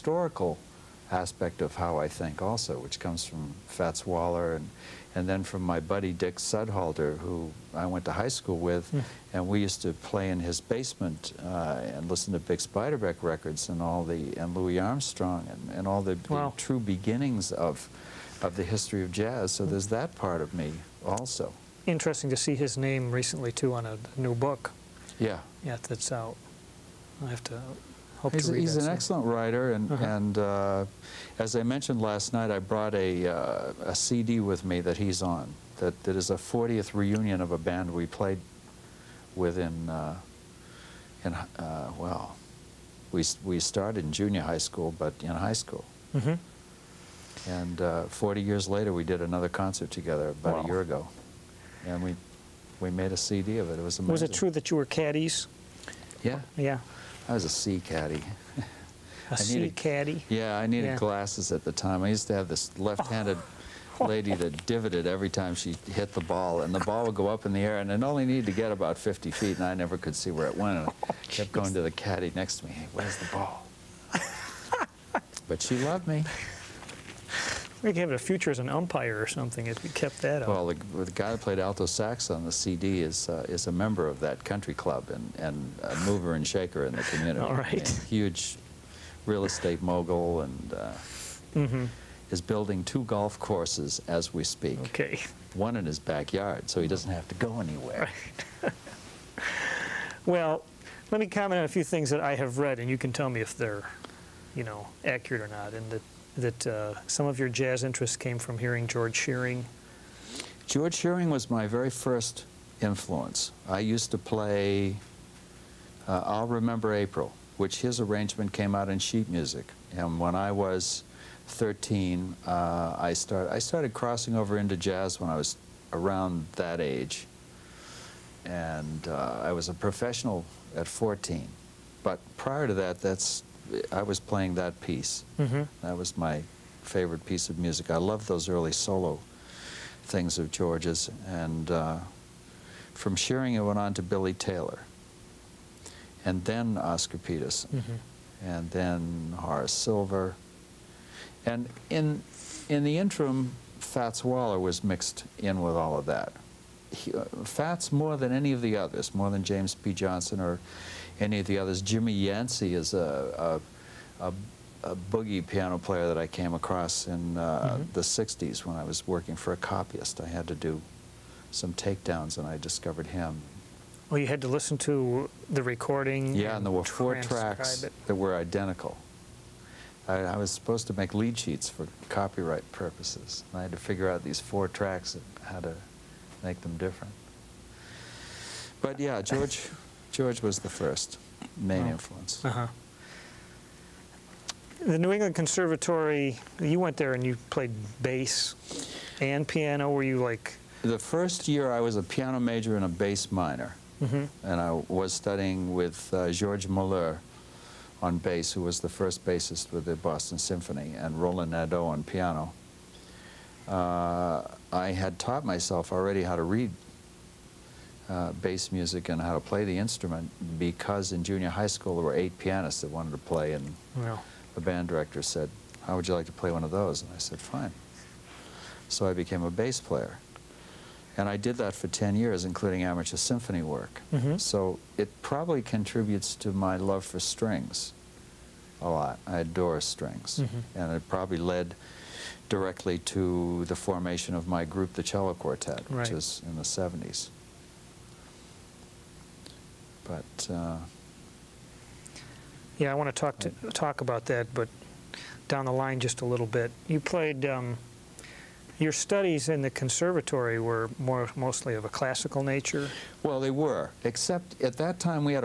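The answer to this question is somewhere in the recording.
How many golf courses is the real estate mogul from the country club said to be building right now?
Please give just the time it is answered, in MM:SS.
01:32.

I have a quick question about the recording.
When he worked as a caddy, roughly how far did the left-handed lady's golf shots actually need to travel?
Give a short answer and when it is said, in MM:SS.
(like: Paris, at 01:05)
about 50 feet, at 01:08.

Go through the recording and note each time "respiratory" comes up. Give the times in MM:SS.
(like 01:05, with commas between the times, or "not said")
not said.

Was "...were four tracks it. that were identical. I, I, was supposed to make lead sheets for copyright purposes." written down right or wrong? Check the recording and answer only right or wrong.
right.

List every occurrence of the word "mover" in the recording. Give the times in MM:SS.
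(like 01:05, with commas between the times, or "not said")
01:26.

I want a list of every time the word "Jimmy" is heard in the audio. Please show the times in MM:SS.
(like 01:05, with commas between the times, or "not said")
02:41.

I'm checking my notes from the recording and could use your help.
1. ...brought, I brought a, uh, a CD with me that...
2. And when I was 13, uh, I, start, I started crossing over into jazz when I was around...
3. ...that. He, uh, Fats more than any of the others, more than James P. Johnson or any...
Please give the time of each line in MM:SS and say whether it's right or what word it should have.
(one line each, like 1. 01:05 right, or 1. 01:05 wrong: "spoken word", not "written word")
1. 00:32 wrong: "night", not "brought"
2. 01:59 right
3. 02:36 right.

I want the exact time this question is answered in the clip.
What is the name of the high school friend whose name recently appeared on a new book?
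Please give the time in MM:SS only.
00:06.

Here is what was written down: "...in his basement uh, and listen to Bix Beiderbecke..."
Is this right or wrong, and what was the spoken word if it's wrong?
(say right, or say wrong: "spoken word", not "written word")
right.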